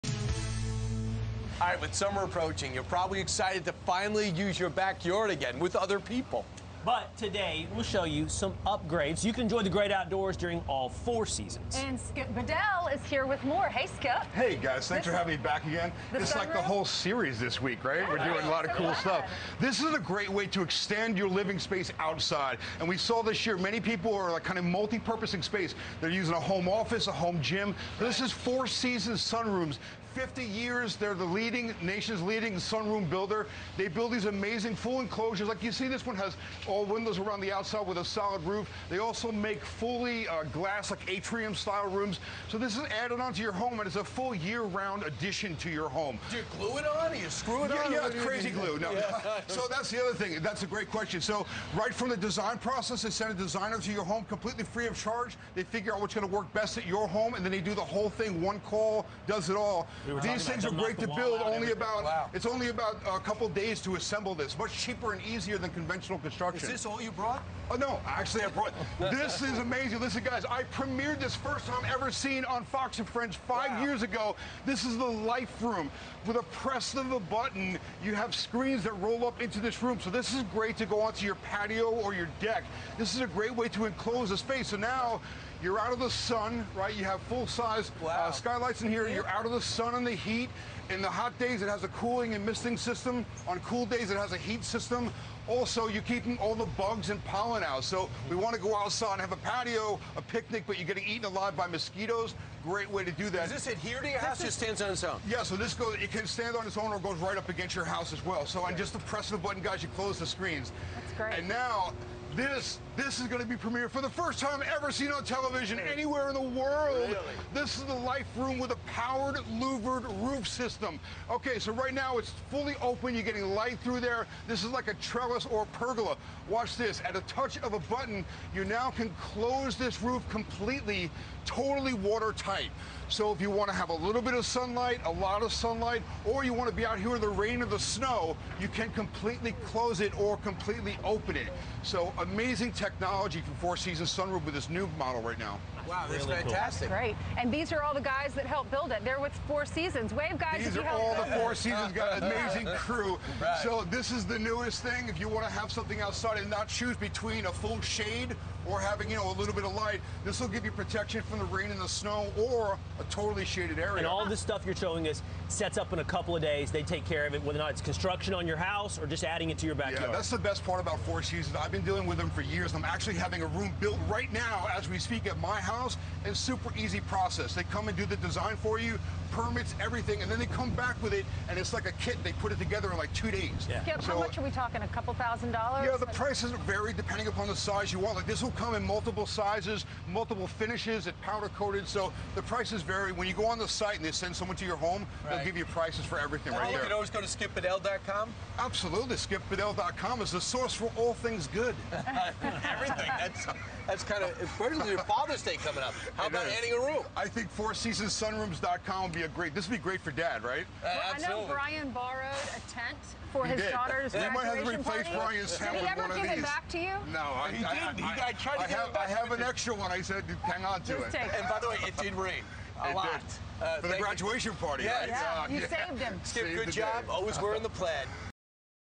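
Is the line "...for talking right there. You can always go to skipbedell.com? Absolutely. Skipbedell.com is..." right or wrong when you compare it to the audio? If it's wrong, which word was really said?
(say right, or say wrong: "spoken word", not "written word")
wrong: "everything", not "talking".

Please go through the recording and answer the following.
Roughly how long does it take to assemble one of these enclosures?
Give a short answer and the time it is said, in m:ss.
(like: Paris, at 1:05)
a couple days, at 1:03.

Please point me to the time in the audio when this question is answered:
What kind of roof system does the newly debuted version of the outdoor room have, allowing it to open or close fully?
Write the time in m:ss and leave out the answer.
1:58.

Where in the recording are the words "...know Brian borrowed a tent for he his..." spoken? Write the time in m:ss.
3:31.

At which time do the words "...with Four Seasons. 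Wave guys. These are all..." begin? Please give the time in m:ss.
2:29.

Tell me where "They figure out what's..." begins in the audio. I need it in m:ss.
0:55.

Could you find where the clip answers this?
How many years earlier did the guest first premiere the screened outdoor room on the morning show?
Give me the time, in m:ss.
1:13.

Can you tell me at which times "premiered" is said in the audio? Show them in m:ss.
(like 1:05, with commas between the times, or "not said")
1:10, 1:53.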